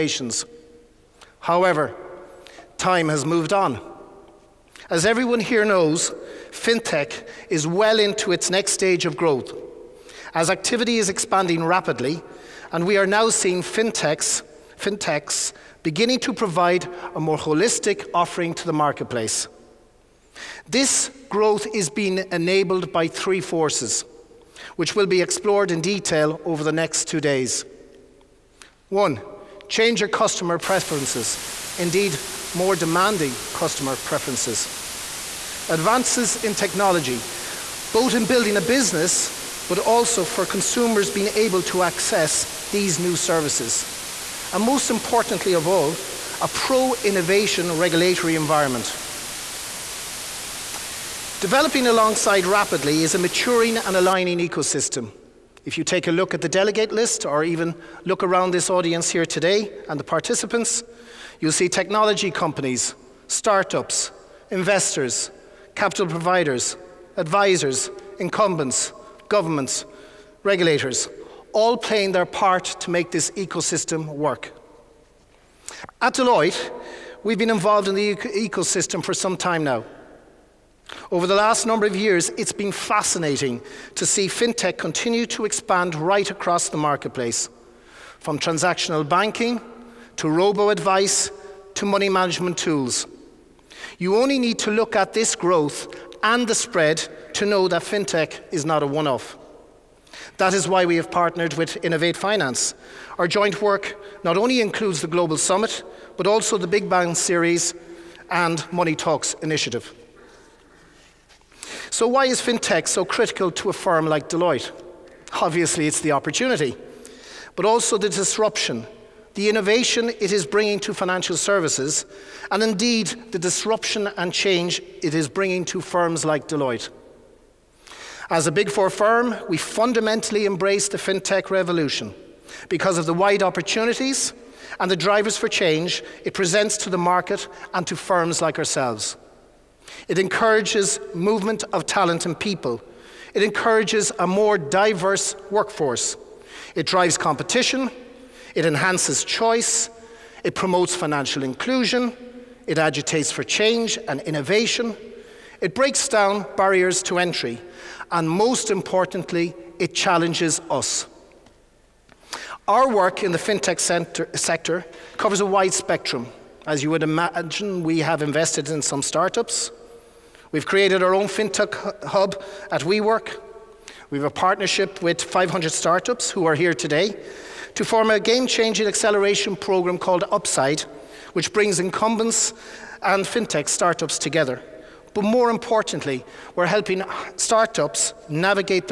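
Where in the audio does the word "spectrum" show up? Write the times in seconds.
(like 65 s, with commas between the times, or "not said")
165 s.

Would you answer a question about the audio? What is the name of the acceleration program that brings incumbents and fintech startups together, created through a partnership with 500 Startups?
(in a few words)
Upside.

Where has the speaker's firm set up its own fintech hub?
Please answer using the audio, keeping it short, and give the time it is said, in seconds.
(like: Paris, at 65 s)
WeWork, at 172 s.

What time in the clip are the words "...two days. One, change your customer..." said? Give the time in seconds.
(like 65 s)
27 s.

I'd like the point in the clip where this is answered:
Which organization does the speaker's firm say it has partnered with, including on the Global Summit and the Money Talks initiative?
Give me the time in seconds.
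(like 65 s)
101 s.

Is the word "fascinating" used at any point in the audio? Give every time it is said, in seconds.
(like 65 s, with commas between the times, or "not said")
82 s.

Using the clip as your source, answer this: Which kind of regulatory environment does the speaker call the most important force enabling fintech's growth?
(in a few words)
Pro innovation.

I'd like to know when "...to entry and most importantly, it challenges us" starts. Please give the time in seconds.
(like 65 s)
157 s.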